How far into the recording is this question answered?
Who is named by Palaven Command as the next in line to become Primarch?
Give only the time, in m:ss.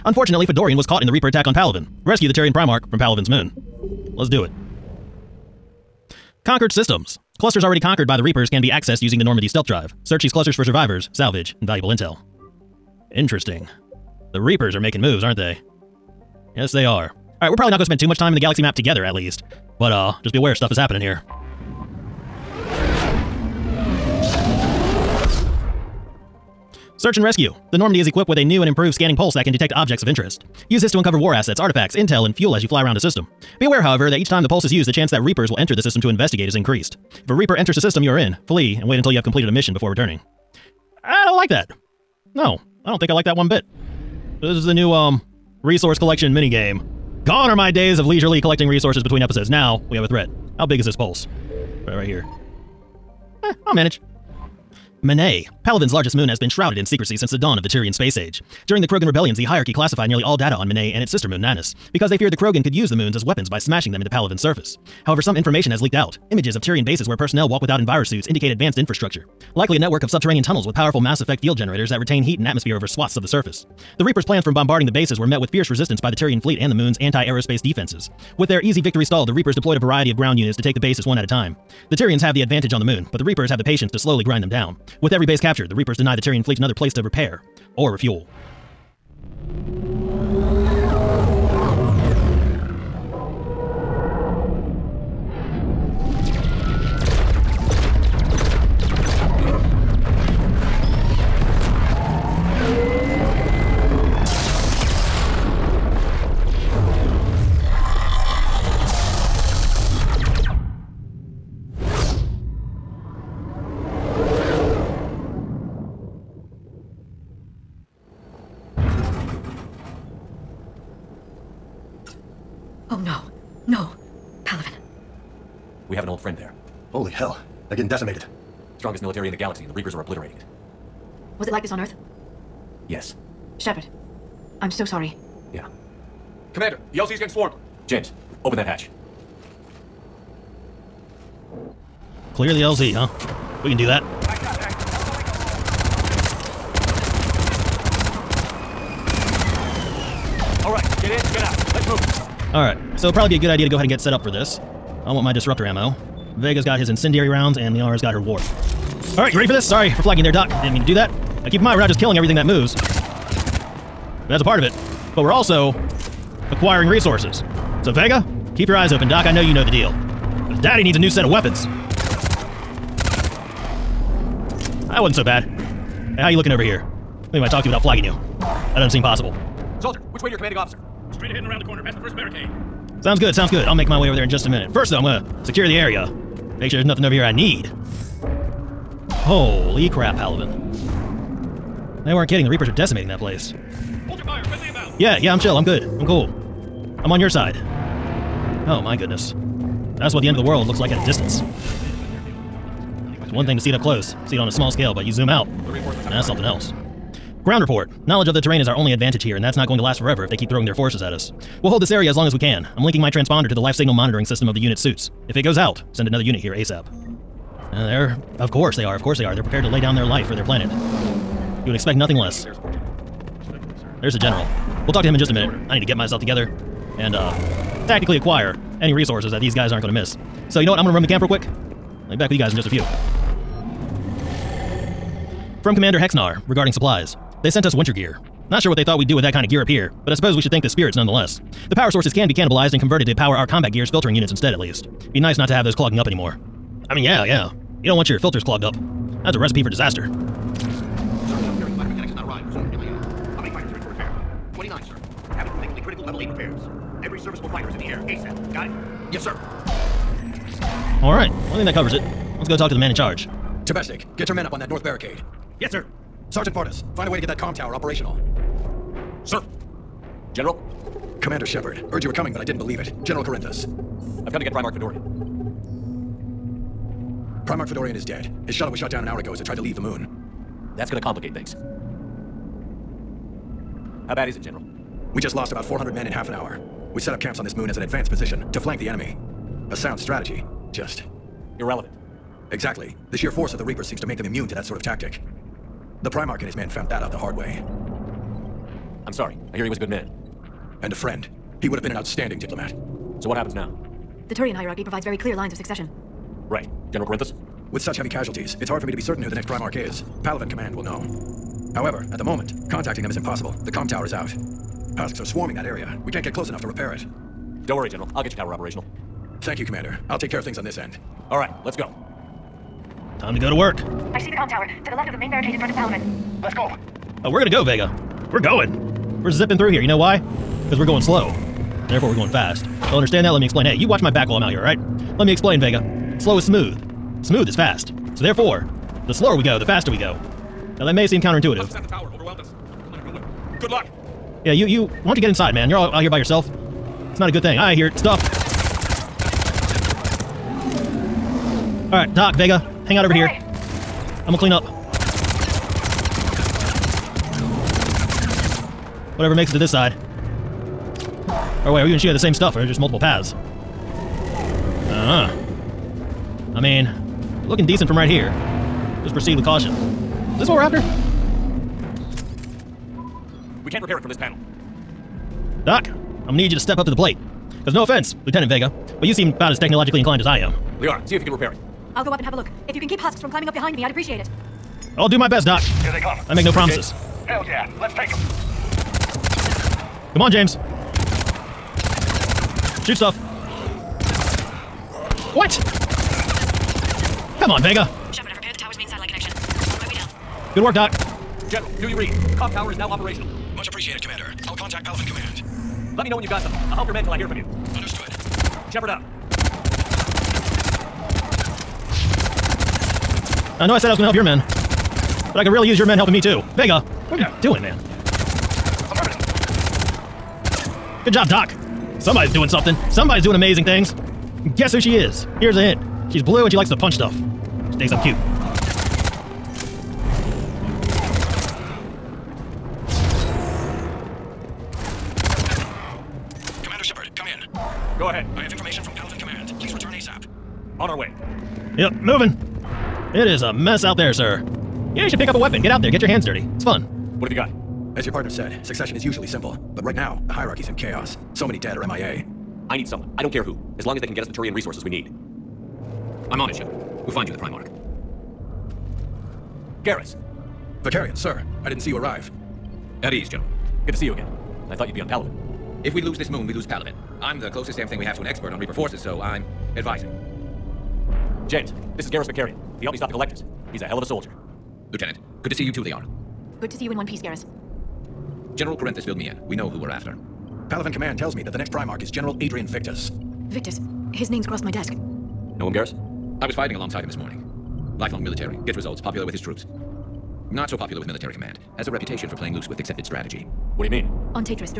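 8:02.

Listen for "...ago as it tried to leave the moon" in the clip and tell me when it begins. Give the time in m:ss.
4:39.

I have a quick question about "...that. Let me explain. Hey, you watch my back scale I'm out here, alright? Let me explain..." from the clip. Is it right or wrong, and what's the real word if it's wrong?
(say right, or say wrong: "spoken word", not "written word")
wrong: "while", not "scale".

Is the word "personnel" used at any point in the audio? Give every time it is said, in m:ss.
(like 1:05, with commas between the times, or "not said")
1:07.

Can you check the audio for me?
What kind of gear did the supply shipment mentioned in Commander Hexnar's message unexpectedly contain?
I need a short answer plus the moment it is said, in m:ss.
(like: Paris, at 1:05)
Winter gear, at 3:57.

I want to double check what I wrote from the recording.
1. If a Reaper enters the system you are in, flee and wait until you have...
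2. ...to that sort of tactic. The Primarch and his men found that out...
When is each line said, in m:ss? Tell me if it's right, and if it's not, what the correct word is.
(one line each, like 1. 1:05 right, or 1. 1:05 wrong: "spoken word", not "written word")
1. 0:37 right
2. 4:54 right.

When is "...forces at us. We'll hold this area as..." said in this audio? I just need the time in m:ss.
3:30.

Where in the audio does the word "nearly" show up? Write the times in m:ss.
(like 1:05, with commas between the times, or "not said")
1:00.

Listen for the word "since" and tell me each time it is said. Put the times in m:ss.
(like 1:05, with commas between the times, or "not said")
0:57.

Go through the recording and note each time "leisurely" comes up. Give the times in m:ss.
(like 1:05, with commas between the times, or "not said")
0:48.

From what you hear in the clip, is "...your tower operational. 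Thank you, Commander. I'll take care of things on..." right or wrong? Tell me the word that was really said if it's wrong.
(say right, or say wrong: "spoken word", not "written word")
right.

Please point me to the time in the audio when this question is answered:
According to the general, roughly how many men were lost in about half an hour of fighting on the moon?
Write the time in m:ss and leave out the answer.
4:45.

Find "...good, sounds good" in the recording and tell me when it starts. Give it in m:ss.
3:03.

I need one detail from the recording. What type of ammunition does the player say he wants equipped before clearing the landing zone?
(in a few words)
Disruptor ammo.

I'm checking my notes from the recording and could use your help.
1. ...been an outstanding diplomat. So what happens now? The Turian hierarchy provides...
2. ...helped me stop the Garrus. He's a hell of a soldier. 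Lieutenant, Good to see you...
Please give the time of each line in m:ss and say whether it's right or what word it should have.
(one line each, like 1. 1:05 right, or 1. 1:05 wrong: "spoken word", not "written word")
1. 5:01 right
2. 7:52 wrong: "Collectors", not "Garrus".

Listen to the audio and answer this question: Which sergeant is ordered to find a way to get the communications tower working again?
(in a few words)
Sergeant Bardas.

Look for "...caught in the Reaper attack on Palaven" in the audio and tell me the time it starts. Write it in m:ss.
0:00.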